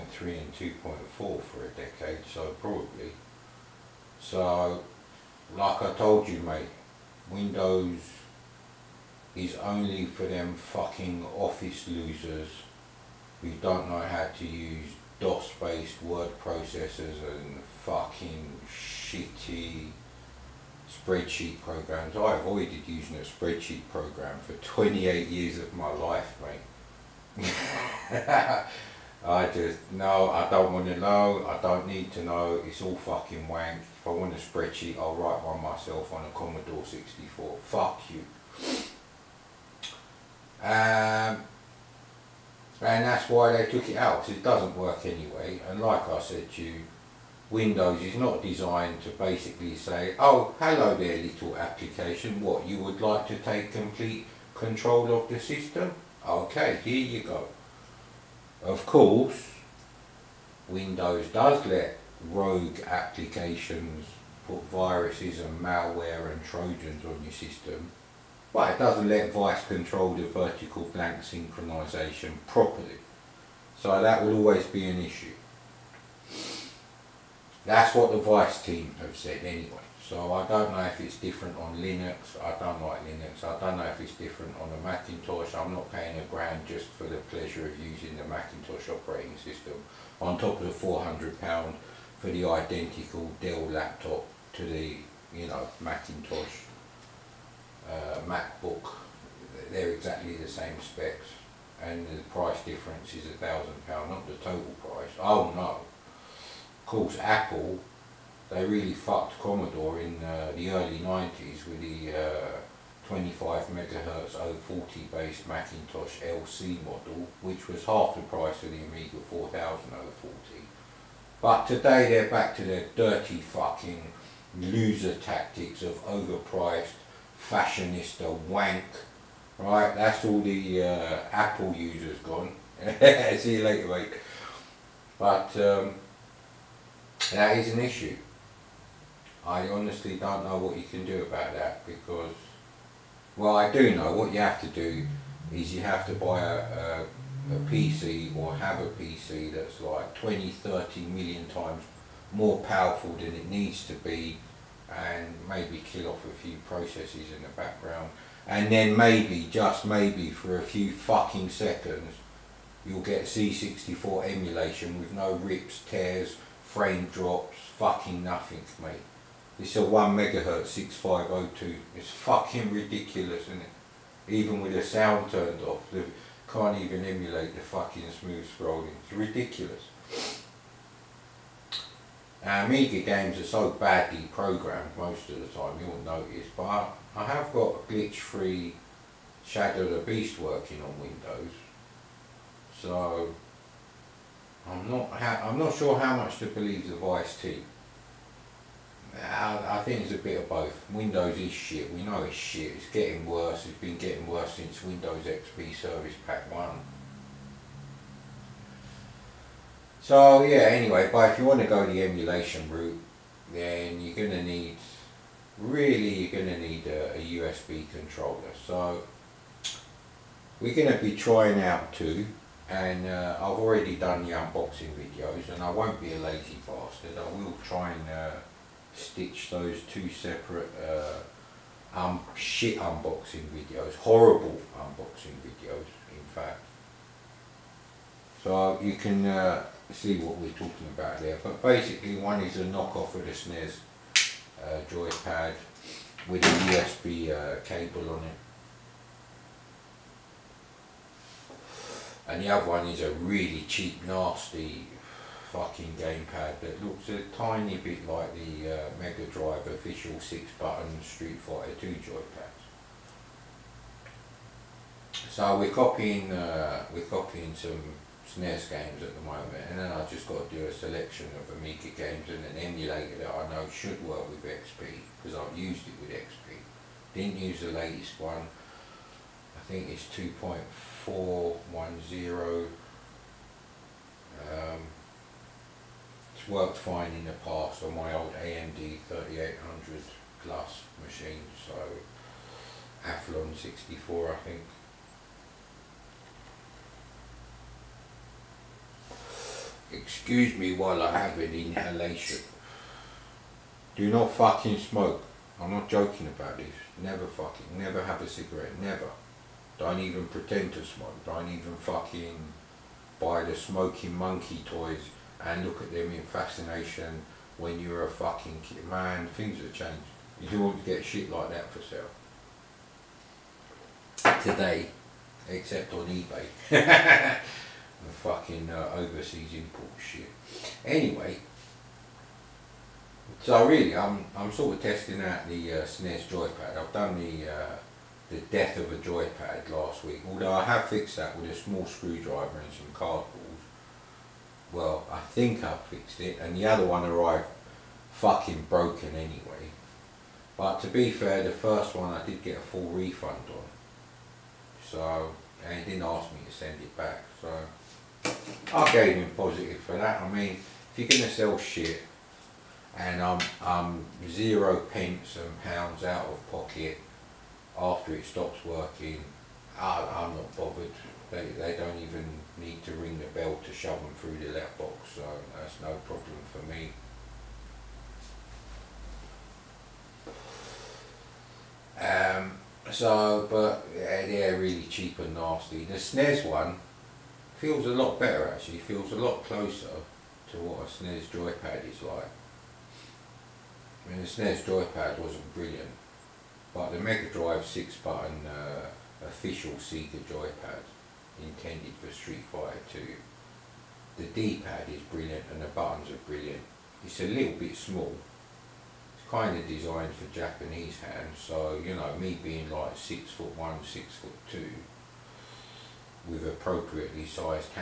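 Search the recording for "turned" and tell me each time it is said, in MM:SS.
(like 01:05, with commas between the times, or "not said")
02:55.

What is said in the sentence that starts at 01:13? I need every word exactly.
So that will always be an issue.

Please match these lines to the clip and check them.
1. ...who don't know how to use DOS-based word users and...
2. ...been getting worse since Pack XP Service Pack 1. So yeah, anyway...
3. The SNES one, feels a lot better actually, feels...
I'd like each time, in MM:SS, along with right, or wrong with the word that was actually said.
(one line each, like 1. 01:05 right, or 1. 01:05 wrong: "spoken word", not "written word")
1. 00:13 wrong: "processors", not "users"
2. 03:23 wrong: "Windows", not "Pack"
3. 06:25 right.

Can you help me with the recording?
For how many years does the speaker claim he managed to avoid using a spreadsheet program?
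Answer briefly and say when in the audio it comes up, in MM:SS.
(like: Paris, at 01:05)
28, at 00:24.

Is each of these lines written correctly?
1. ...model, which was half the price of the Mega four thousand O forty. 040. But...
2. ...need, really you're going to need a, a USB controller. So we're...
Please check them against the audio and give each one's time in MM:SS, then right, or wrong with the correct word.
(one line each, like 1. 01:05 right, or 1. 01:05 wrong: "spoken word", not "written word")
1. 01:56 wrong: "Amiga", not "Mega"
2. 03:34 right.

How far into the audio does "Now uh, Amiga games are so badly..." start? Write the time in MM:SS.
03:02.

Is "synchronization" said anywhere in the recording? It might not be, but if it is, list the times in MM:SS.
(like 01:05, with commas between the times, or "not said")
01:11.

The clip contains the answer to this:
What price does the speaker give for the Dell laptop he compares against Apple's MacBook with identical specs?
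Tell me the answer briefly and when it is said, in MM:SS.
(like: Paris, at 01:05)
£400, at 01:30.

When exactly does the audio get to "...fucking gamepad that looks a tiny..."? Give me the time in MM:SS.
04:15.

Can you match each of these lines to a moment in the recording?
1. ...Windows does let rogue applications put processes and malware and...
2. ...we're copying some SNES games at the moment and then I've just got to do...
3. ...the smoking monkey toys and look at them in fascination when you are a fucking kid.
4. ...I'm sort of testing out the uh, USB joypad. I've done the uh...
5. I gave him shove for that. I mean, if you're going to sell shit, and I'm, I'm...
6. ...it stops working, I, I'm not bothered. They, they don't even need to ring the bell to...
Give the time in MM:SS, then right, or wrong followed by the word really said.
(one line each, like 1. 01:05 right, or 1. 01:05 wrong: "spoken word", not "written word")
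1. 01:00 wrong: "viruses", not "processes"
2. 04:26 right
3. 05:13 right
4. 05:34 wrong: "SNES", not "USB"
5. 05:58 wrong: "positive", not "shove"
6. 06:08 right.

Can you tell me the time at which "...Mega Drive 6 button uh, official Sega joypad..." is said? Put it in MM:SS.
06:36.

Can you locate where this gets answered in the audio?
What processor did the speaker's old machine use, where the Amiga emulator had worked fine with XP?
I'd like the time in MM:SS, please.
04:48.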